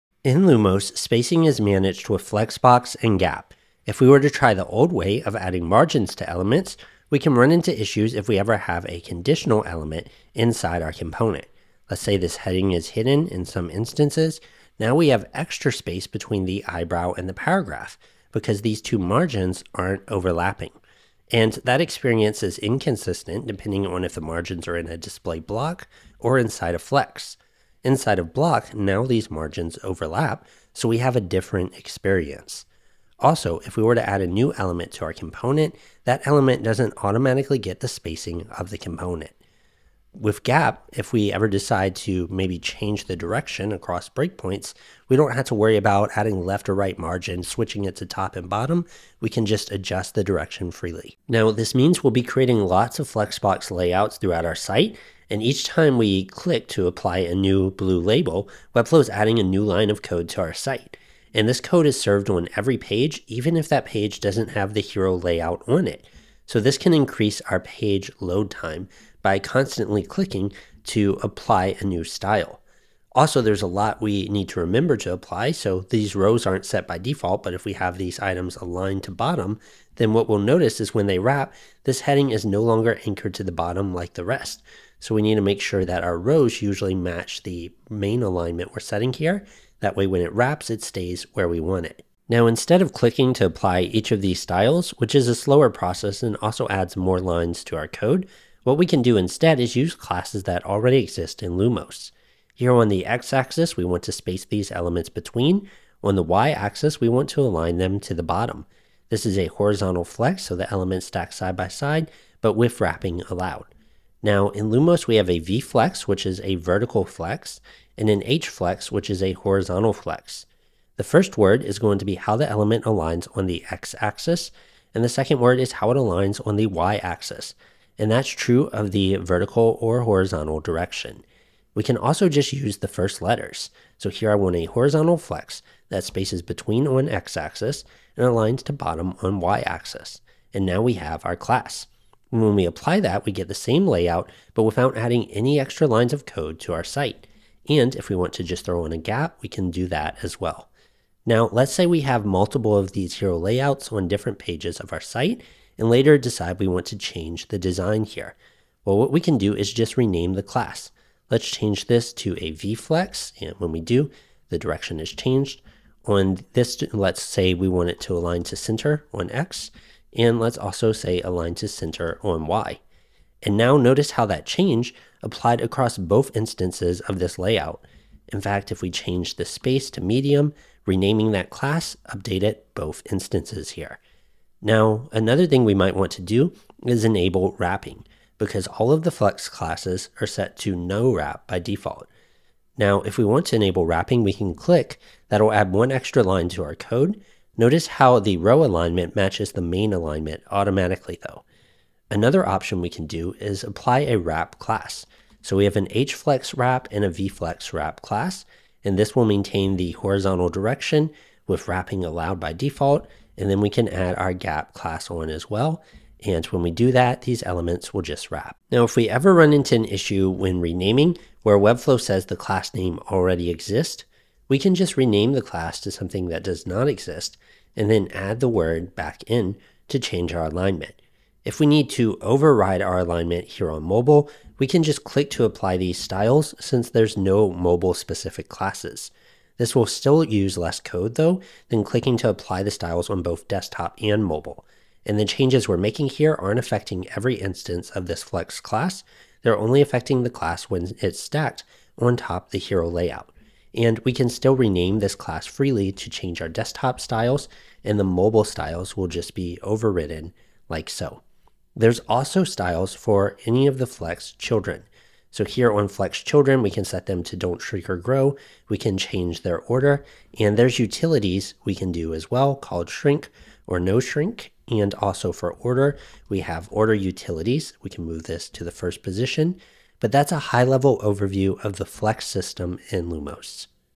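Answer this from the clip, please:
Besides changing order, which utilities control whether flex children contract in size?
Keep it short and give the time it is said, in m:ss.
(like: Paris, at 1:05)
Shrink or No Shrink, at 4:32.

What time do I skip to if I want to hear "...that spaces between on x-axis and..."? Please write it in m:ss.
2:15.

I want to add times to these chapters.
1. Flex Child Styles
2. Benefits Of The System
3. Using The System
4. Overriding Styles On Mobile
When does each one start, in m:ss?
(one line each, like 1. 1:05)
1. 4:22
2. 0:51
3. 1:32
4. 3:51.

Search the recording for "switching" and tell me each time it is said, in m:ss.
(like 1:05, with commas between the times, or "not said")
0:47.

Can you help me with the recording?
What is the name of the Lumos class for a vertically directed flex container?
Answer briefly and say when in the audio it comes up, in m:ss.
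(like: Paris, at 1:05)
V flex, at 1:55.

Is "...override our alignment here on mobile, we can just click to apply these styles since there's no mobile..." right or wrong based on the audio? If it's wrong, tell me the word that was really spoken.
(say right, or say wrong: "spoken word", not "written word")
right.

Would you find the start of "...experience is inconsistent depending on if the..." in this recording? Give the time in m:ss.
0:21.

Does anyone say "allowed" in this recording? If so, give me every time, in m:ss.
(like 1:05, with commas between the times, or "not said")
1:53, 3:32.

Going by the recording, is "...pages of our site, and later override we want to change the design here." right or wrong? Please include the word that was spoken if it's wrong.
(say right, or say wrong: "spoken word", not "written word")
wrong: "decide", not "override".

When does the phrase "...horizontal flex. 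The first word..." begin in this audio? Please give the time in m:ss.
1:59.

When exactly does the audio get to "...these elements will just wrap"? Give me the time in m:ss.
3:37.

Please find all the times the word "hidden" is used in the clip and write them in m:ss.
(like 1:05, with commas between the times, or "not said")
0:12.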